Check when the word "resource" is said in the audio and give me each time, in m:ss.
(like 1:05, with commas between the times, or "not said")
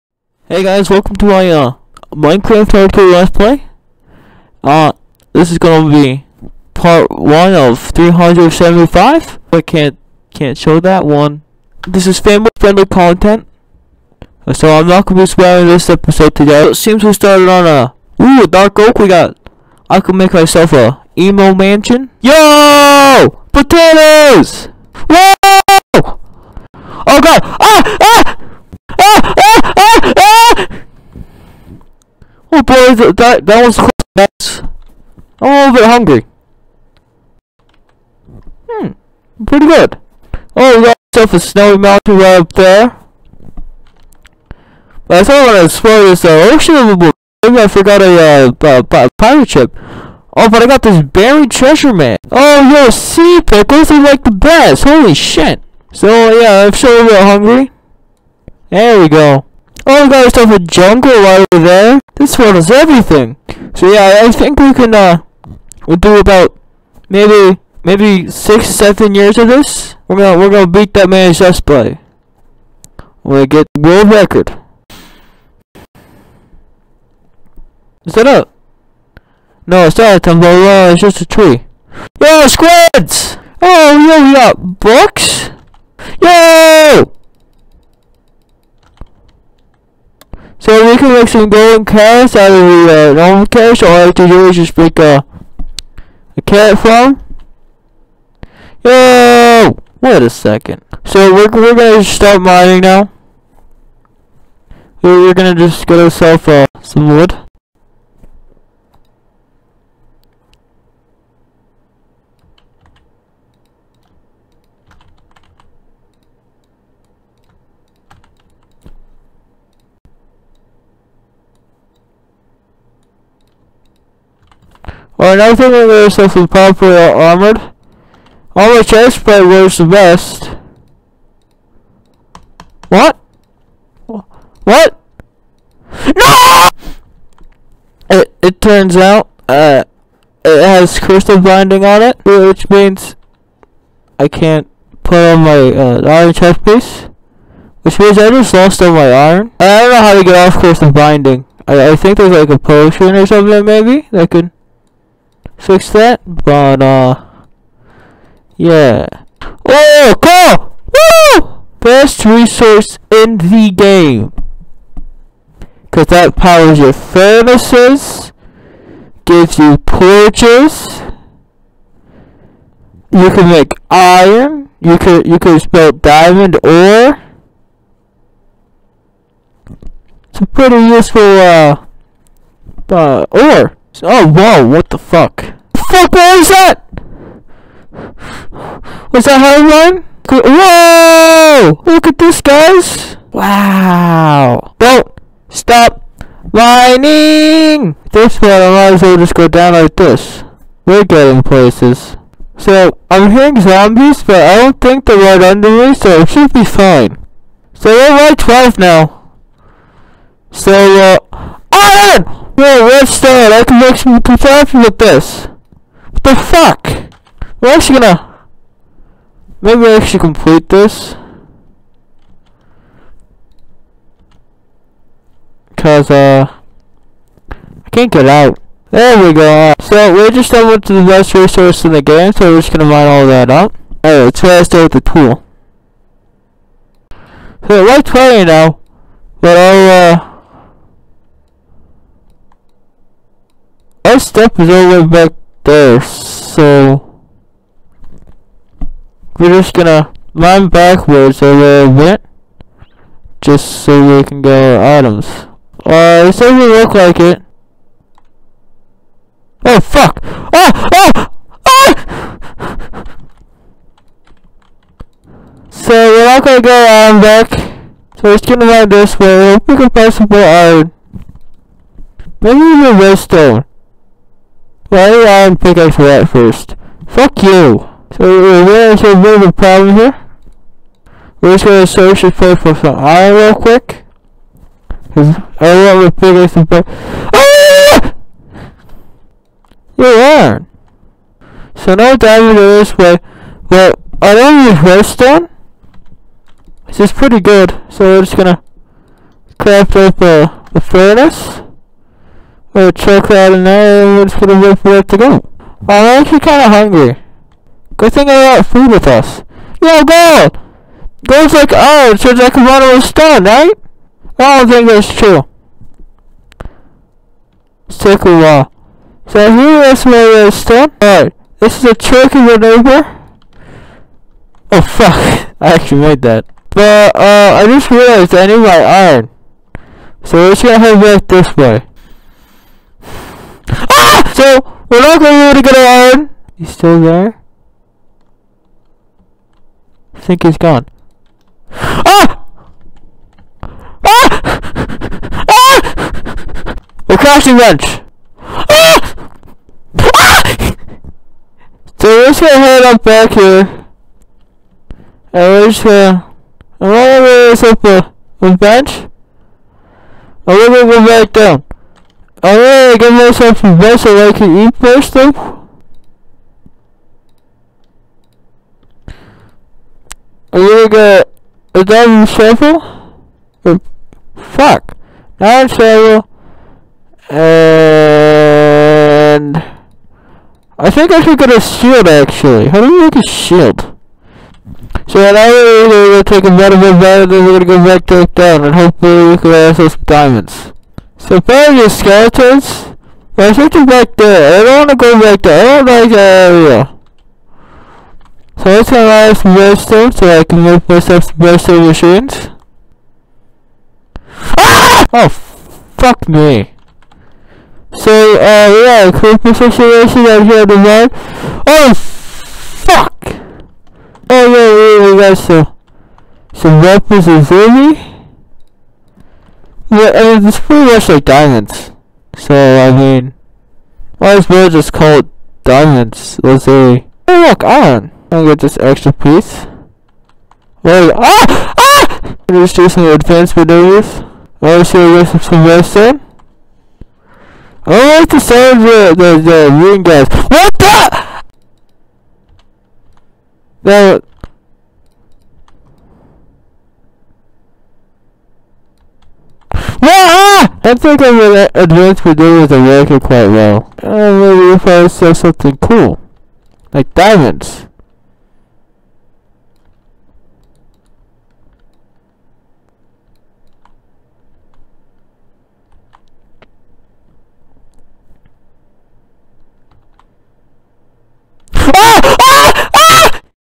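2:42, 3:51.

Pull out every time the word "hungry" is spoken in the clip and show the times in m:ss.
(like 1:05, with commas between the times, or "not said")
0:35, 0:57, 5:06.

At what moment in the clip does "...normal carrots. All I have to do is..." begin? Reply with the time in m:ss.
1:33.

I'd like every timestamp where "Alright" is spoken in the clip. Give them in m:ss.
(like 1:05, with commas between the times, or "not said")
3:54, 5:21, 6:02.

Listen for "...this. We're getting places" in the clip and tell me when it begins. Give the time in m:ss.
3:19.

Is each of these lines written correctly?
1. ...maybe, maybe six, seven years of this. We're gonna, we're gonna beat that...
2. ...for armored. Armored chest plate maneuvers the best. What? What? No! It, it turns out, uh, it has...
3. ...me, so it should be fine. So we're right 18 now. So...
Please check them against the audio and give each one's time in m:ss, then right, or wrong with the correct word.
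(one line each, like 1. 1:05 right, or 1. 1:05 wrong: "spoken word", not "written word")
1. 1:07 right
2. 2:06 wrong: "wears", not "maneuvers"
3. 3:25 wrong: "12", not "18".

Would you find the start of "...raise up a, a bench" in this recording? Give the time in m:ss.
5:57.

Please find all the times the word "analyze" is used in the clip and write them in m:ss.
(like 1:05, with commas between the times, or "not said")
6:38.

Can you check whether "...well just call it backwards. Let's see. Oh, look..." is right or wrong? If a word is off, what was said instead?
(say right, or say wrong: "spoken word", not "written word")
wrong: "diamonds", not "backwards".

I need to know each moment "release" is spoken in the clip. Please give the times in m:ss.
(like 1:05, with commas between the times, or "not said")
not said.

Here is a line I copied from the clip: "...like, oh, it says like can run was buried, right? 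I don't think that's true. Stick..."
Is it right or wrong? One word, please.
wrong.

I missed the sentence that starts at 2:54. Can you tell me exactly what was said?
You could you could smelt diamond ore.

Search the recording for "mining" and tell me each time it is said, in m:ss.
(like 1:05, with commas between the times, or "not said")
1:42, 3:16.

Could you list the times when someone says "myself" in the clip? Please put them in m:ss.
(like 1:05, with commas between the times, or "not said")
0:20, 6:03, 6:40.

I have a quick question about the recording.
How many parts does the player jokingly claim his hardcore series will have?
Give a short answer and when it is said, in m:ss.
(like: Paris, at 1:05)
375, at 0:07.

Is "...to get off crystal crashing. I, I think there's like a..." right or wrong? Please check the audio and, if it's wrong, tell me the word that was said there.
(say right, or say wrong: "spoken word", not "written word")
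wrong: "binding", not "crashing".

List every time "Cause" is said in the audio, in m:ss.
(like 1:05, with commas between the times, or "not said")
2:45, 3:45, 4:45.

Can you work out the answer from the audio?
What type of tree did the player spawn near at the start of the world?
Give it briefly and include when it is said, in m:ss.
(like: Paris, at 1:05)
dark oak, at 0:18.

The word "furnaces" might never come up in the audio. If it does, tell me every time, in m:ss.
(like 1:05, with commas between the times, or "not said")
2:46, 5:00.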